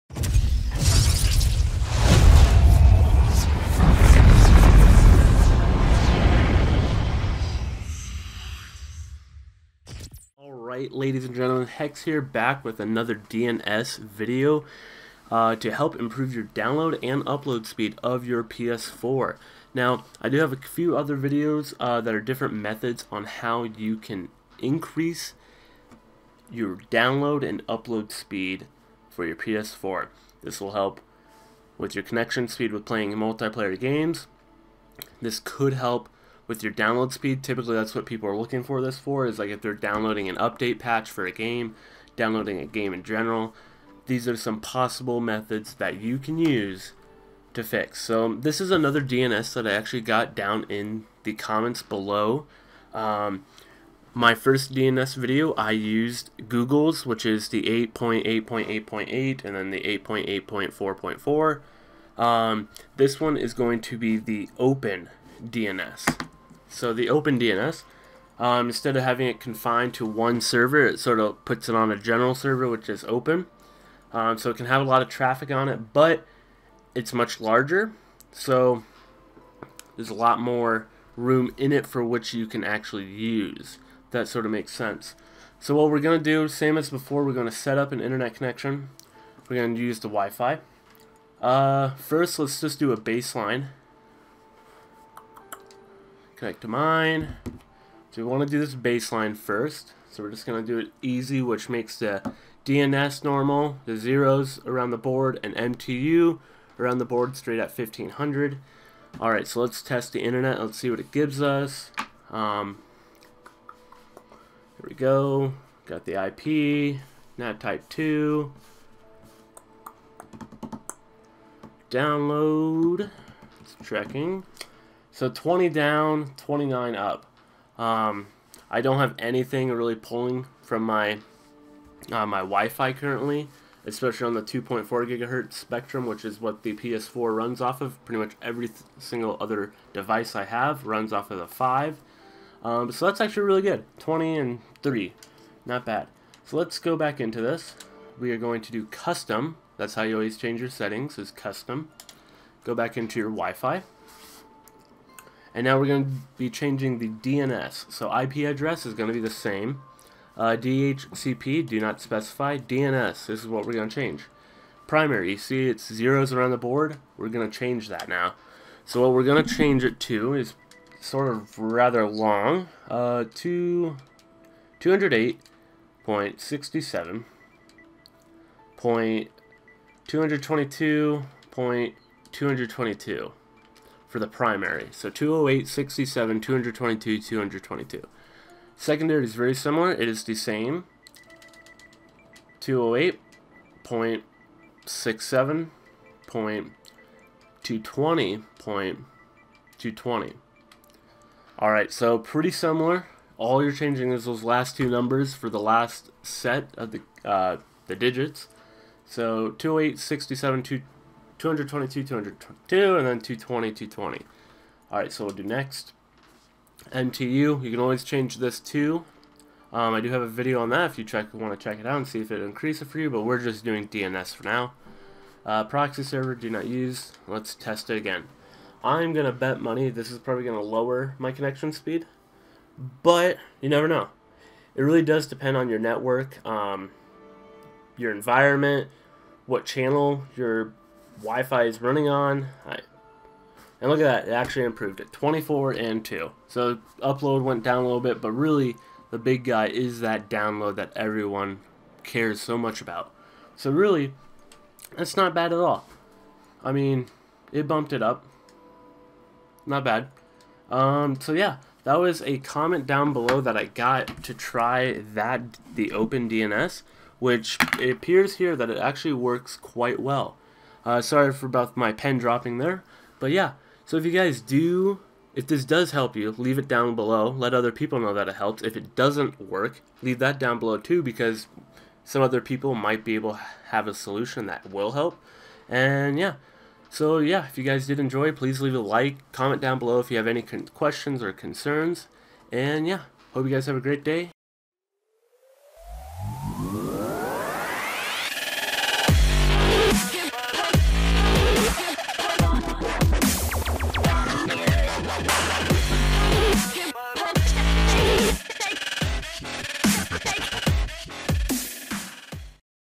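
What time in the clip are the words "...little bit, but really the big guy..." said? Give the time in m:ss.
4:07.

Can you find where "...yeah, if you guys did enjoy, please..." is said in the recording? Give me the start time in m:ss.
4:47.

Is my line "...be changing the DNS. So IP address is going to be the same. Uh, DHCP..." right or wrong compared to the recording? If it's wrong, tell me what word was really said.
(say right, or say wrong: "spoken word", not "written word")
right.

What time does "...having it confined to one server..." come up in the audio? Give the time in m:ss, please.
1:09.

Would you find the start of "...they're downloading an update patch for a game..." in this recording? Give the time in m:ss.
0:39.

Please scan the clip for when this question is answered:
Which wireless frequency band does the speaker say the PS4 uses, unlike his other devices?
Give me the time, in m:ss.
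2:14.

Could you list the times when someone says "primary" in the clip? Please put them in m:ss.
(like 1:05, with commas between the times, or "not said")
2:44, 3:04.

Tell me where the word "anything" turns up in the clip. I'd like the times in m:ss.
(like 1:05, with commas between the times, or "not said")
2:09.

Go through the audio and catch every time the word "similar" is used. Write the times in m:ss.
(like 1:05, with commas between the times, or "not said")
3:09, 3:22.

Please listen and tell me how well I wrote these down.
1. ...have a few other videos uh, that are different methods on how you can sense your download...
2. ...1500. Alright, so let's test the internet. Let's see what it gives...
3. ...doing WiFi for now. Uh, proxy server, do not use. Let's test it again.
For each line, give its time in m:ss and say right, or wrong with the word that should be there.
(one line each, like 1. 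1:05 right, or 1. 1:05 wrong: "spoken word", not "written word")
1. 0:20 wrong: "increase", not "sense"
2. 1:47 right
3. 3:43 wrong: "DNS", not "WiFi".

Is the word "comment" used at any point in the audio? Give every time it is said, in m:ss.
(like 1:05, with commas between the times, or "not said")
0:51, 4:22, 4:49.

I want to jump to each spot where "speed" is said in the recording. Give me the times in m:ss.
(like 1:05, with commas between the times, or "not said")
0:17, 0:28, 0:32, 0:37, 3:51.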